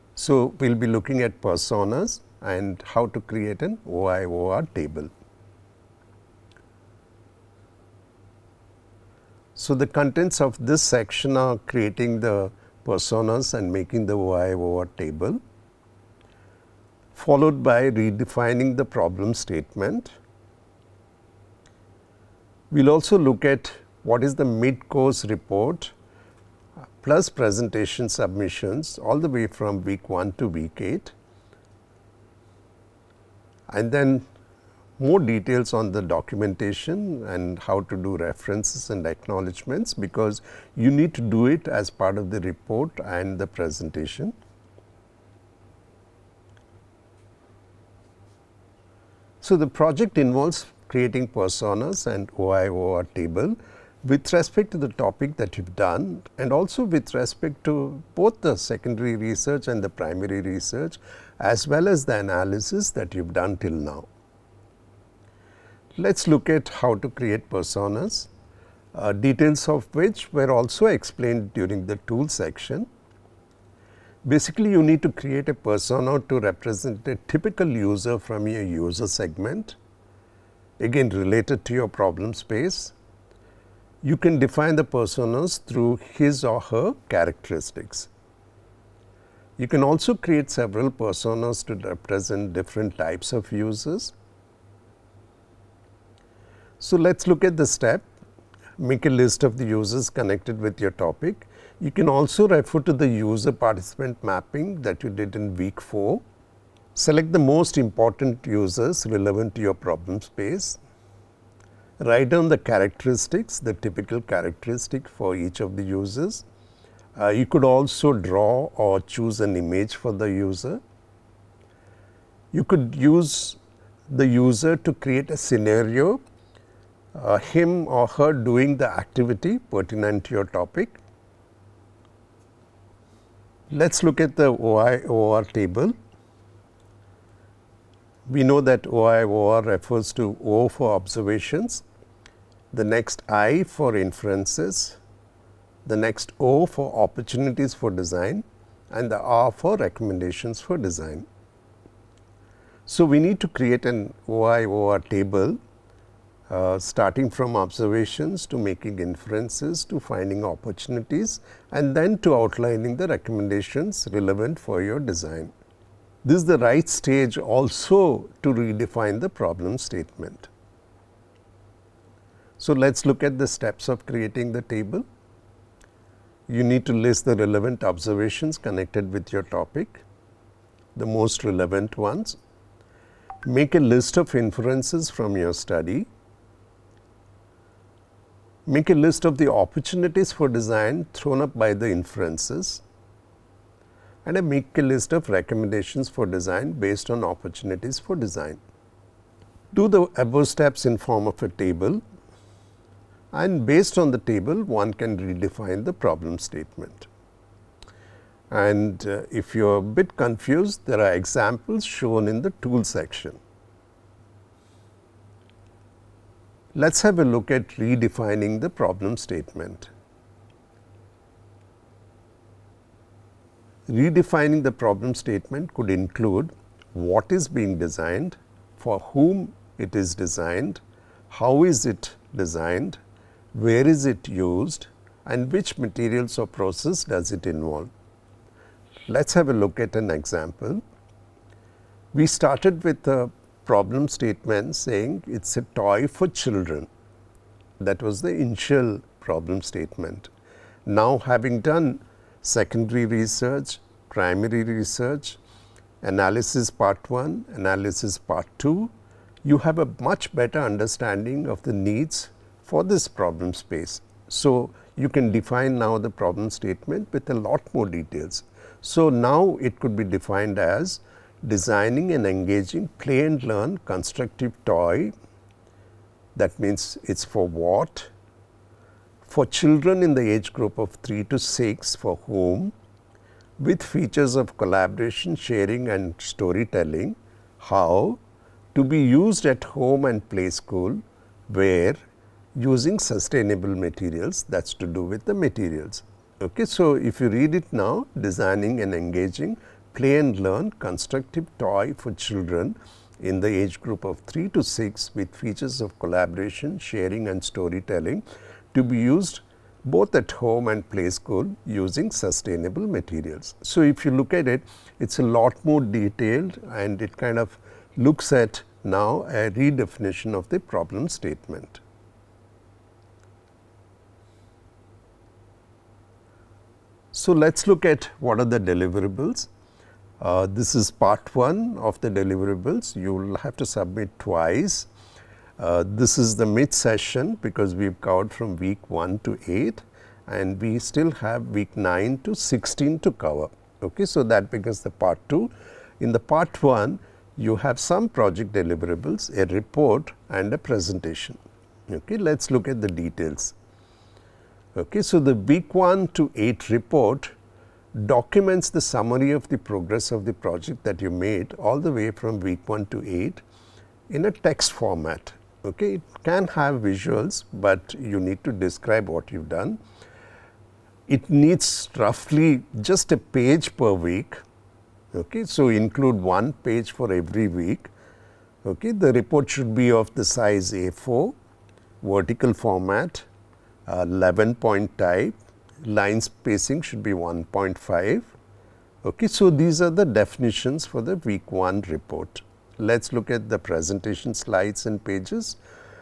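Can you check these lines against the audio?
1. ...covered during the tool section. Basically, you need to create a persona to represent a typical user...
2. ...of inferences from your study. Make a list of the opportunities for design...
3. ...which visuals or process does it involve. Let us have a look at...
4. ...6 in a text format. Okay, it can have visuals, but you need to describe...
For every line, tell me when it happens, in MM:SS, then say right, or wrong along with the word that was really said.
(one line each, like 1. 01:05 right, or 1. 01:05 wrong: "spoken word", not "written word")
1. 01:10 wrong: "explained", not "covered"
2. 03:04 right
3. 03:55 wrong: "materials", not "visuals"
4. 06:03 wrong: "8", not "6".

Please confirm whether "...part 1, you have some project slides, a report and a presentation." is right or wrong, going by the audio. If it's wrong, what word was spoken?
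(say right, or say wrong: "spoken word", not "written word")
wrong: "deliverables", not "slides".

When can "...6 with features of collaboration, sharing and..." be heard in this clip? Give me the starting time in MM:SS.
05:04.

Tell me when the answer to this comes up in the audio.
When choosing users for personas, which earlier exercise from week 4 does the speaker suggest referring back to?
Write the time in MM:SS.
01:43.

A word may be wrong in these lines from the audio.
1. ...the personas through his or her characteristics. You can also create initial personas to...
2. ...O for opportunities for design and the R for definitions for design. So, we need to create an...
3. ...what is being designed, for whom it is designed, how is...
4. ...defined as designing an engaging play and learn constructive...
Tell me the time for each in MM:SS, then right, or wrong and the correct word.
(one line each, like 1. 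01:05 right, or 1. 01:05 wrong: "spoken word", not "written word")
1. 01:24 wrong: "several", not "initial"
2. 02:26 wrong: "recommendations", not "definitions"
3. 03:46 right
4. 04:30 right.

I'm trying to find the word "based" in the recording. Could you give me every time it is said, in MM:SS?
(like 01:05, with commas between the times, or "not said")
03:16, 03:23.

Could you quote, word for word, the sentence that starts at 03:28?
And uh, if you are a bit confused there are examples shown in the tool section.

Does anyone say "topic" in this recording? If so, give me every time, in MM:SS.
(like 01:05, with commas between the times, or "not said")
00:54, 01:40, 02:10, 02:59.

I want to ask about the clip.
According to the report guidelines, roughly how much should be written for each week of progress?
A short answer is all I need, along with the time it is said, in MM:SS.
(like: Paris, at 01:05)
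a page per week, at 06:13.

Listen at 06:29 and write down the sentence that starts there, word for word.
Okay, so these are the definitions for the week 1 report.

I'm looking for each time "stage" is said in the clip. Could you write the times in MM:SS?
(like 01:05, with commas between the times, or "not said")
02:46.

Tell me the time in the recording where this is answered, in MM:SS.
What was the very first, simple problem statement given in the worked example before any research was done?
04:05.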